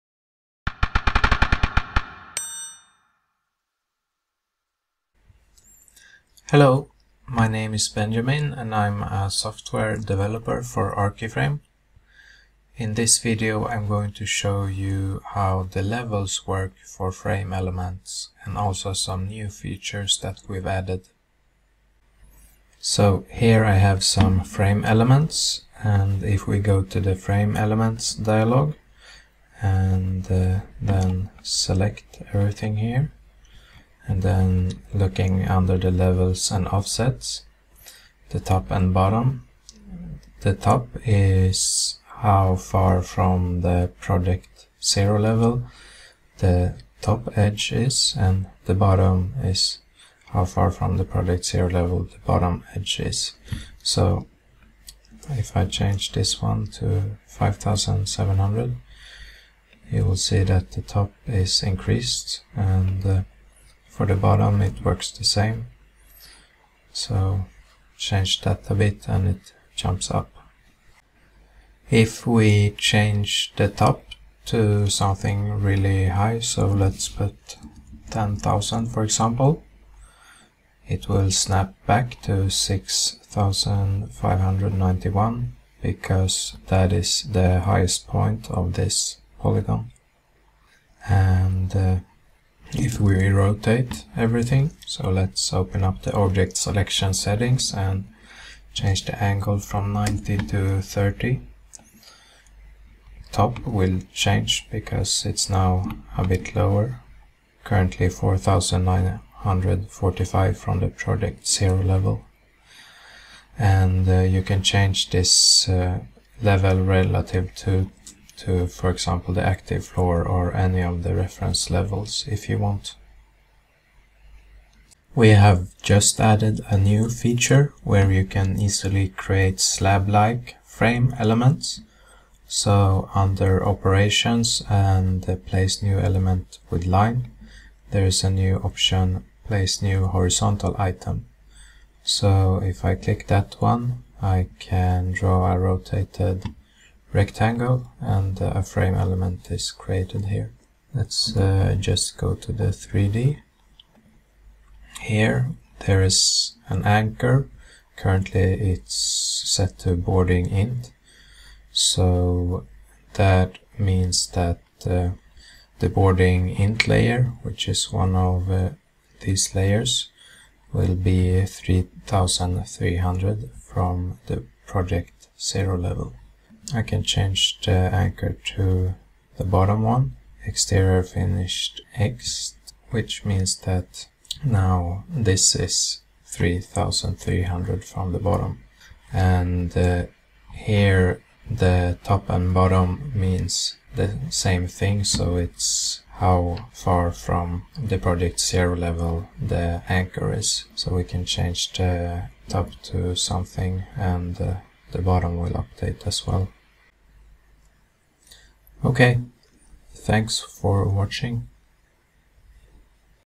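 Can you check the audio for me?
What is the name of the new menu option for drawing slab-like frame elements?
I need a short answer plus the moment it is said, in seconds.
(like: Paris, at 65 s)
Place new horizontal item, at 139 s.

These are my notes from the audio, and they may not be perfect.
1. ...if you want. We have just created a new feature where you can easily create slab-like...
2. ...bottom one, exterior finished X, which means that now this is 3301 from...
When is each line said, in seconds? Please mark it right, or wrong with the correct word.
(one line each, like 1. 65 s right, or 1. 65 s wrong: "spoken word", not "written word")
1. 122 s wrong: "added", not "created"
2. 179 s wrong: "3300", not "3301".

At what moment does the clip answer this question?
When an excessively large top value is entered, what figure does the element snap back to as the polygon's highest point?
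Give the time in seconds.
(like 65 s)
82 s.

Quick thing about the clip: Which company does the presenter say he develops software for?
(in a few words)
Archiframe.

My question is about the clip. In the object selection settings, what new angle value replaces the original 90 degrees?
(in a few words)
30.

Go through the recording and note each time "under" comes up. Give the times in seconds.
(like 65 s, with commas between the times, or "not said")
35 s, 133 s.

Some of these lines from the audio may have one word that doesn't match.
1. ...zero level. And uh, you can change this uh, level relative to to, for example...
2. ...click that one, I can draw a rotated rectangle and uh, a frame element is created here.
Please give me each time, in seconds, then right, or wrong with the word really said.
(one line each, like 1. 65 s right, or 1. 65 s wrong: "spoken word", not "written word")
1. 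111 s right
2. 142 s right.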